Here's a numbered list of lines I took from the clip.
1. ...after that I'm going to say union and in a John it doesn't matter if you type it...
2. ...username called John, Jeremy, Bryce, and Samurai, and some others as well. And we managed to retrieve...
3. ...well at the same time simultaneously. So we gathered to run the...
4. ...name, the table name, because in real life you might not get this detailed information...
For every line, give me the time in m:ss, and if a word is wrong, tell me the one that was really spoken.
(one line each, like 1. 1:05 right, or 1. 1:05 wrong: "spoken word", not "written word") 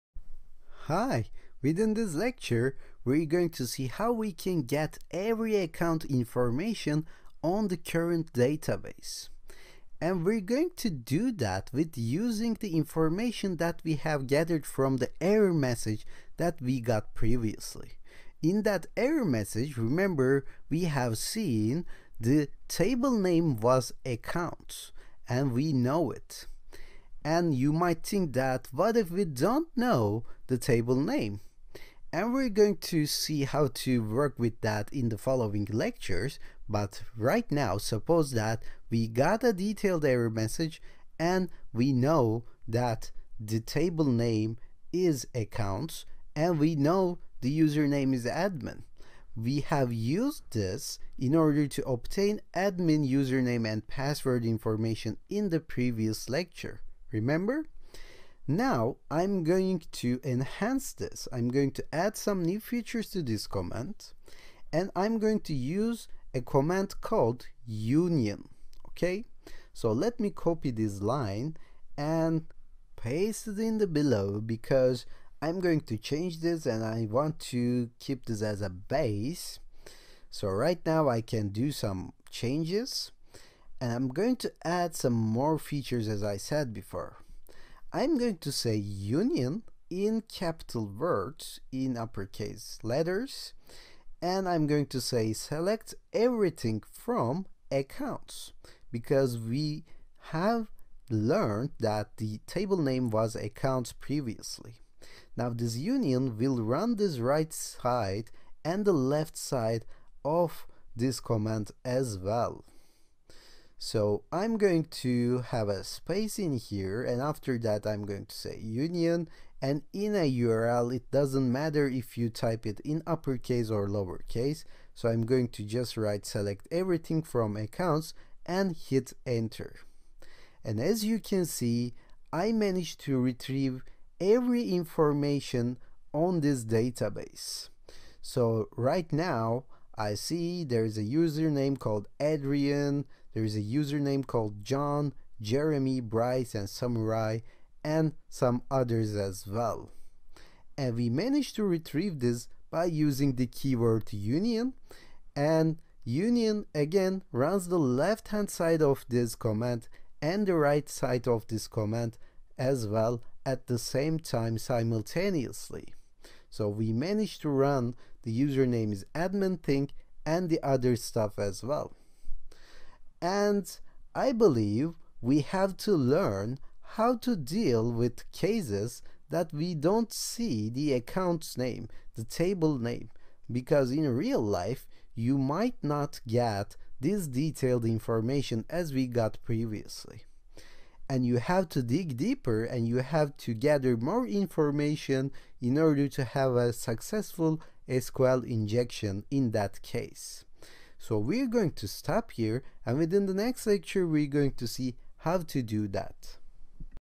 1. 1:57 wrong: "URL", not "John"
2. 2:23 right
3. 2:42 wrong: "managed", not "gathered"
4. 3:01 right.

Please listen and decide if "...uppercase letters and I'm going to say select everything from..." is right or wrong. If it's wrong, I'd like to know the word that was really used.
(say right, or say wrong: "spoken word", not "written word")
right.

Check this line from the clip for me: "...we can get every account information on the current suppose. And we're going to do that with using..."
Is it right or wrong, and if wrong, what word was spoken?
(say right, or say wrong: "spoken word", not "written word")
wrong: "database", not "suppose".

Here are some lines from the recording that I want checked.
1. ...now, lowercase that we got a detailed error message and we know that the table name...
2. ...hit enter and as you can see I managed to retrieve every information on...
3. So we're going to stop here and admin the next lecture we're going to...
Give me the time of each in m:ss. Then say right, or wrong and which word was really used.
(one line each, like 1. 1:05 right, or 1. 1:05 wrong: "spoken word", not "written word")
1. 0:37 wrong: "suppose", not "lowercase"
2. 2:08 right
3. 3:21 wrong: "within", not "admin".